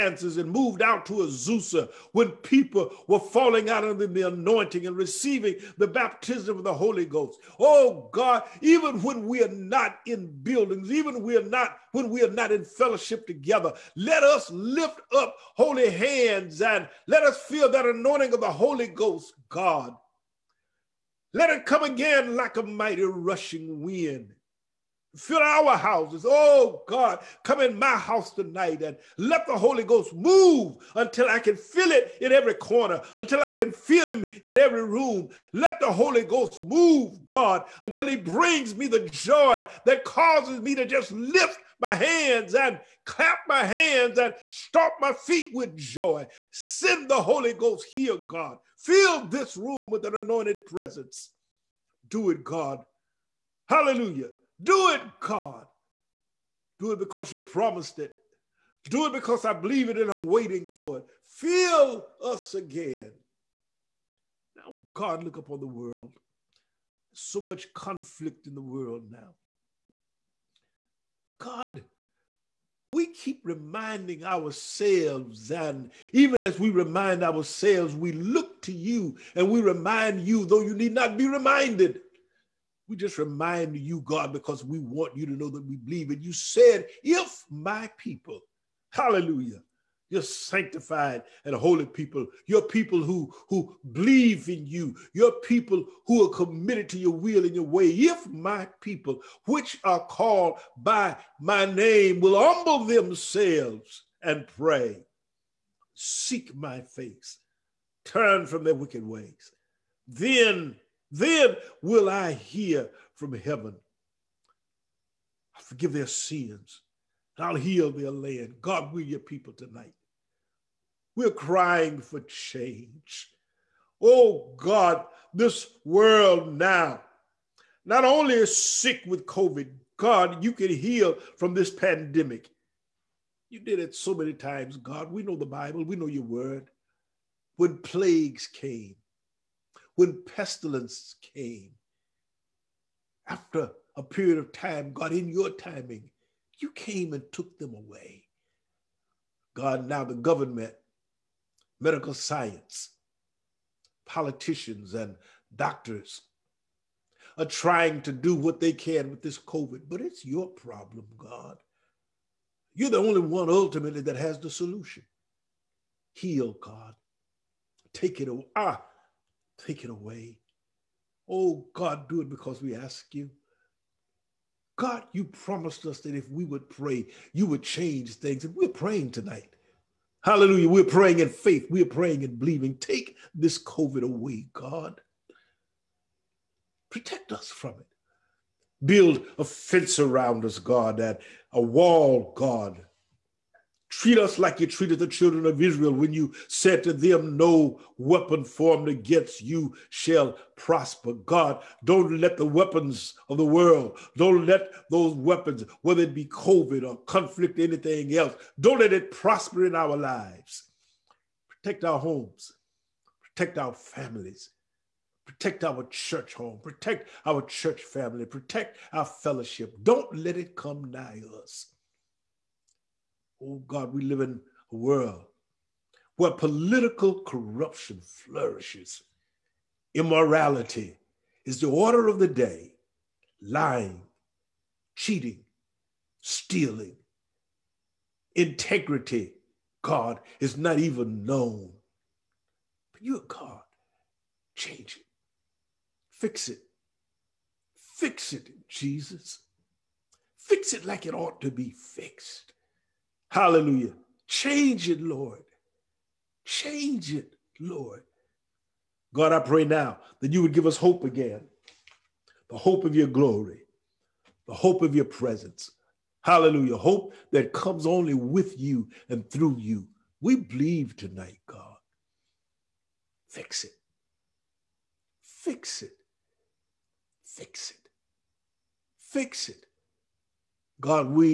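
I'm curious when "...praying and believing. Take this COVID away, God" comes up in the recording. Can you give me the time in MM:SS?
03:01.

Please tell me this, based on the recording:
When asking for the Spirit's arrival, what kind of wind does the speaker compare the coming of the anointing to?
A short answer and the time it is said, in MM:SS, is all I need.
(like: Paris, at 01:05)
mighty rushing wind, at 00:22.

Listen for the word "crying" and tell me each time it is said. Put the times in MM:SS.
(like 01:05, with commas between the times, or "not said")
02:01.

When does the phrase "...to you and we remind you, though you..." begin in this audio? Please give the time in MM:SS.
01:18.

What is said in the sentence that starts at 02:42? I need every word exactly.
You're the only one ultimately that has the solution.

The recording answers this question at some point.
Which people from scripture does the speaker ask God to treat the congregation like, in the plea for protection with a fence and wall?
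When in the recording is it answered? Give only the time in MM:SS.
03:15.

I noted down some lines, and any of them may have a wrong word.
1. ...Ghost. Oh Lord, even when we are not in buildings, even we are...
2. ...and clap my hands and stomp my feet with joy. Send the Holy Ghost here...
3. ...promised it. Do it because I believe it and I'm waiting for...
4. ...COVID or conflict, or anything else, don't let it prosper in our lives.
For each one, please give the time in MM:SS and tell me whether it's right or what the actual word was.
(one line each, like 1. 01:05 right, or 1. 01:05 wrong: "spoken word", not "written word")
1. 00:07 wrong: "God", not "Lord"
2. 00:42 right
3. 00:57 right
4. 03:26 right.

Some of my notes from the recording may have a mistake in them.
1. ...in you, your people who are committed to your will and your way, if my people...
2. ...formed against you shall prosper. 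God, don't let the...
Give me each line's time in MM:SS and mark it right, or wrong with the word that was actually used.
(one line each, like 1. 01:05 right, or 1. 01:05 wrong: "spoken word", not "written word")
1. 01:34 right
2. 03:18 right.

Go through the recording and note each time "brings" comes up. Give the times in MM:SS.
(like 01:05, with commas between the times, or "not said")
00:38.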